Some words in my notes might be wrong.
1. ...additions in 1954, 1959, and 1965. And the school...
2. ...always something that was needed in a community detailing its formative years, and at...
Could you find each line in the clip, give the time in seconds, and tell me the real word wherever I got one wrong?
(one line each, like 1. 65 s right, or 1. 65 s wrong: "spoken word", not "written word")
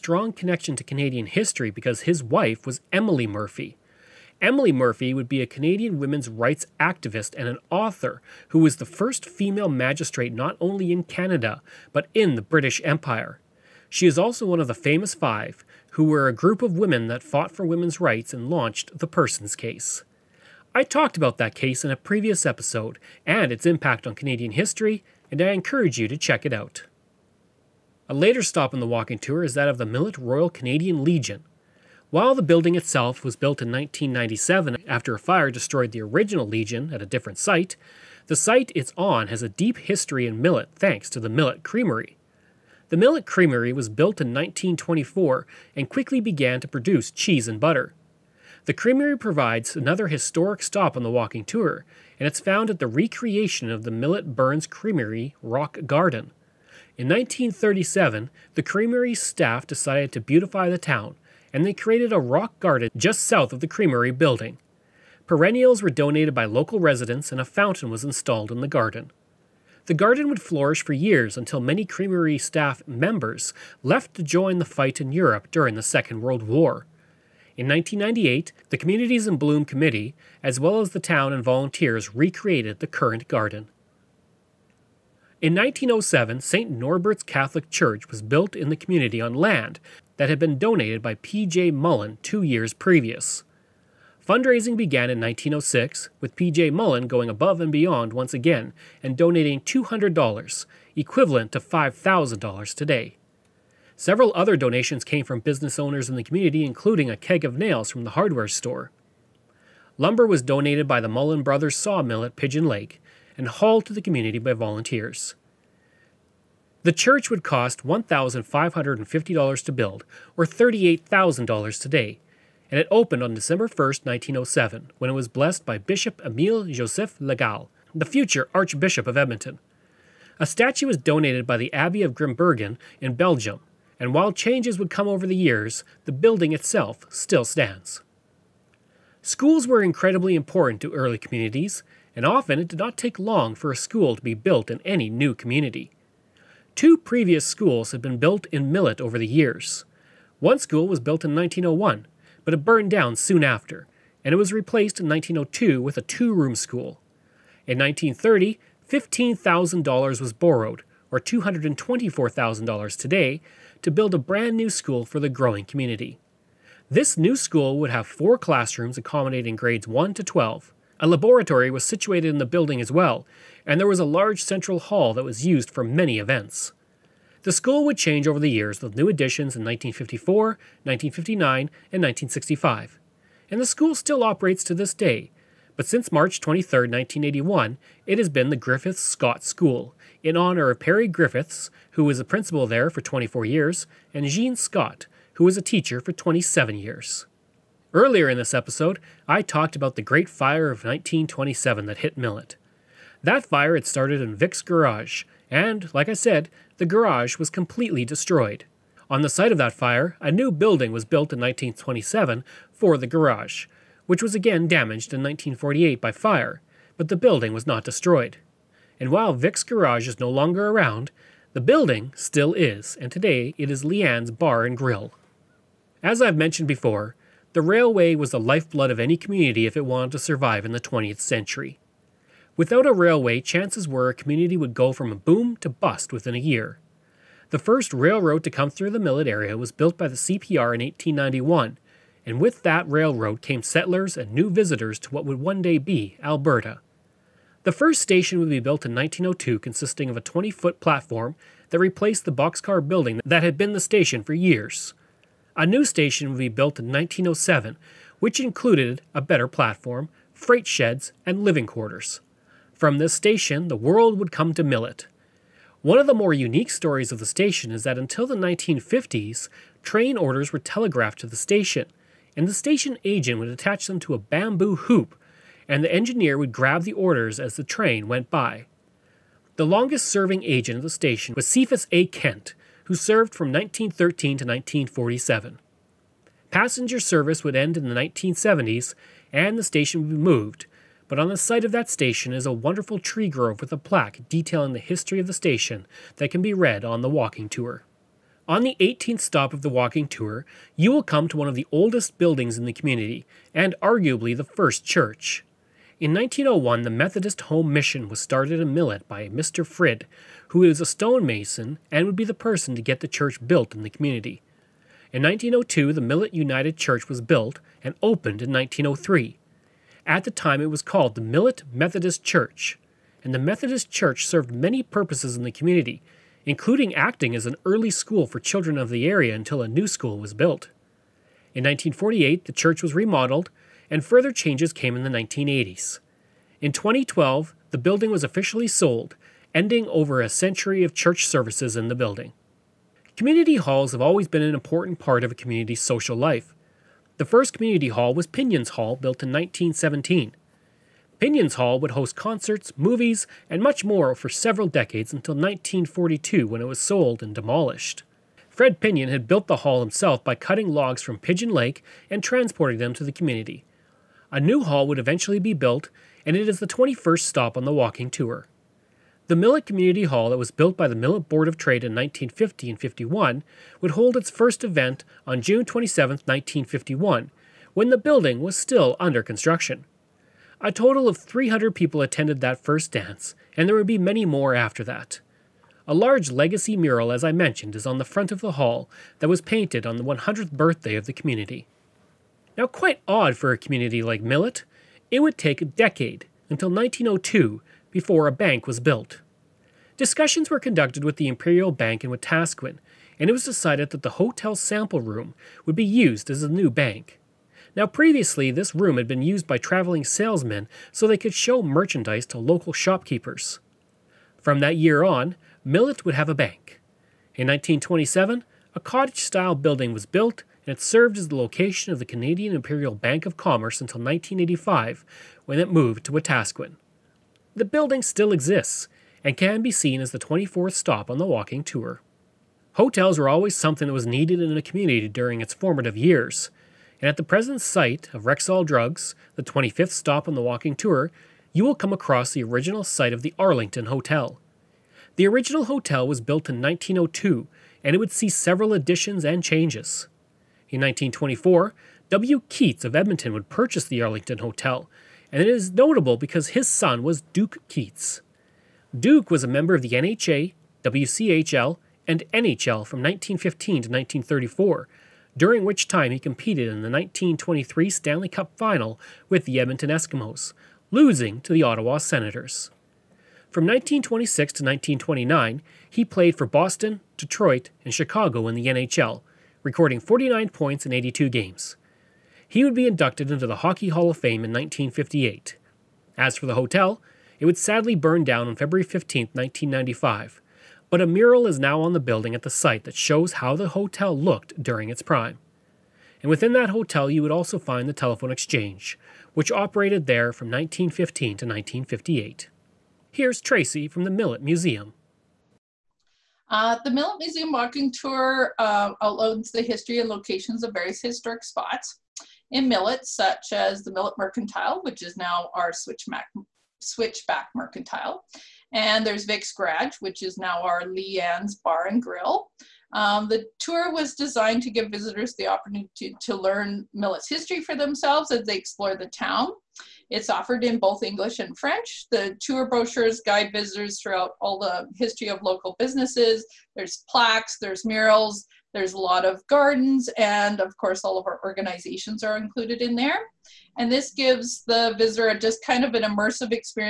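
1. 179 s right
2. 433 s wrong: "during", not "detailing".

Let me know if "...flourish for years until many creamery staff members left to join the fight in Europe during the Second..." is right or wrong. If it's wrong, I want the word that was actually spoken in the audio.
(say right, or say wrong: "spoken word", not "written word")
right.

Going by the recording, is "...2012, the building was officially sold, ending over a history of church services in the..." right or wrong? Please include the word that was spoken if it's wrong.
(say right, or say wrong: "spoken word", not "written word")
wrong: "century", not "history".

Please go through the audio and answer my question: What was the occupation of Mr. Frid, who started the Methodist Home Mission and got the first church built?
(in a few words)
Stonemason.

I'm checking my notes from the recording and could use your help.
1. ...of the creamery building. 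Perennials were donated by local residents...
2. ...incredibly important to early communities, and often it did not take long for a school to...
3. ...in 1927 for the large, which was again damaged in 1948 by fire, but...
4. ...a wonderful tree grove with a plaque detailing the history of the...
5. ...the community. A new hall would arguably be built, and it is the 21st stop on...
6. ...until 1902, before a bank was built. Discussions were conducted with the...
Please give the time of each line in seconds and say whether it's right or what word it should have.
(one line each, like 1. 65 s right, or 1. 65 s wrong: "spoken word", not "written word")
1. 63 s right
2. 139 s right
3. 211 s wrong: "garage", not "large"
4. 292 s right
5. 363 s wrong: "eventually", not "arguably"
6. 396 s right.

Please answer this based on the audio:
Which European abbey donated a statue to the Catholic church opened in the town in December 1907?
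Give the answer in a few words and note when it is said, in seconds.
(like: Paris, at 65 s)
Abbey of Grimbergen, at 131 s.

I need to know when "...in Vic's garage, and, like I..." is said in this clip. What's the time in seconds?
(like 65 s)
204 s.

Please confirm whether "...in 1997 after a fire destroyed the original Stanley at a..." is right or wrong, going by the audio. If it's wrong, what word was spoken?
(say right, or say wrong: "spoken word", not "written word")
wrong: "Legion", not "Stanley".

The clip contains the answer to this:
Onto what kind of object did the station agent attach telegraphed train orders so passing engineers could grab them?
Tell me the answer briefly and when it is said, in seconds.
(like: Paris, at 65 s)
Bamboo hoop, at 274 s.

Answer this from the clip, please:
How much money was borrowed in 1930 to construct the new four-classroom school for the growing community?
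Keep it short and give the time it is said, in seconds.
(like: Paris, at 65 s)
$15,000, at 158 s.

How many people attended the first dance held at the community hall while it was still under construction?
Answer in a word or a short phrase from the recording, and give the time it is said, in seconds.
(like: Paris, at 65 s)
300, at 381 s.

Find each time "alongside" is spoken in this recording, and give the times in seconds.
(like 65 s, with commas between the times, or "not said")
not said.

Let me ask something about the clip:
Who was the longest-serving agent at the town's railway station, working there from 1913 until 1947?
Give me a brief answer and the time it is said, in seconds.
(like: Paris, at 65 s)
Cephas A. Kent, at 281 s.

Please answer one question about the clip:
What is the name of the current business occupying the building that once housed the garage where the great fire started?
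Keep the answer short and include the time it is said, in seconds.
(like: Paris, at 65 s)
Leanne's Bar and Grill, at 223 s.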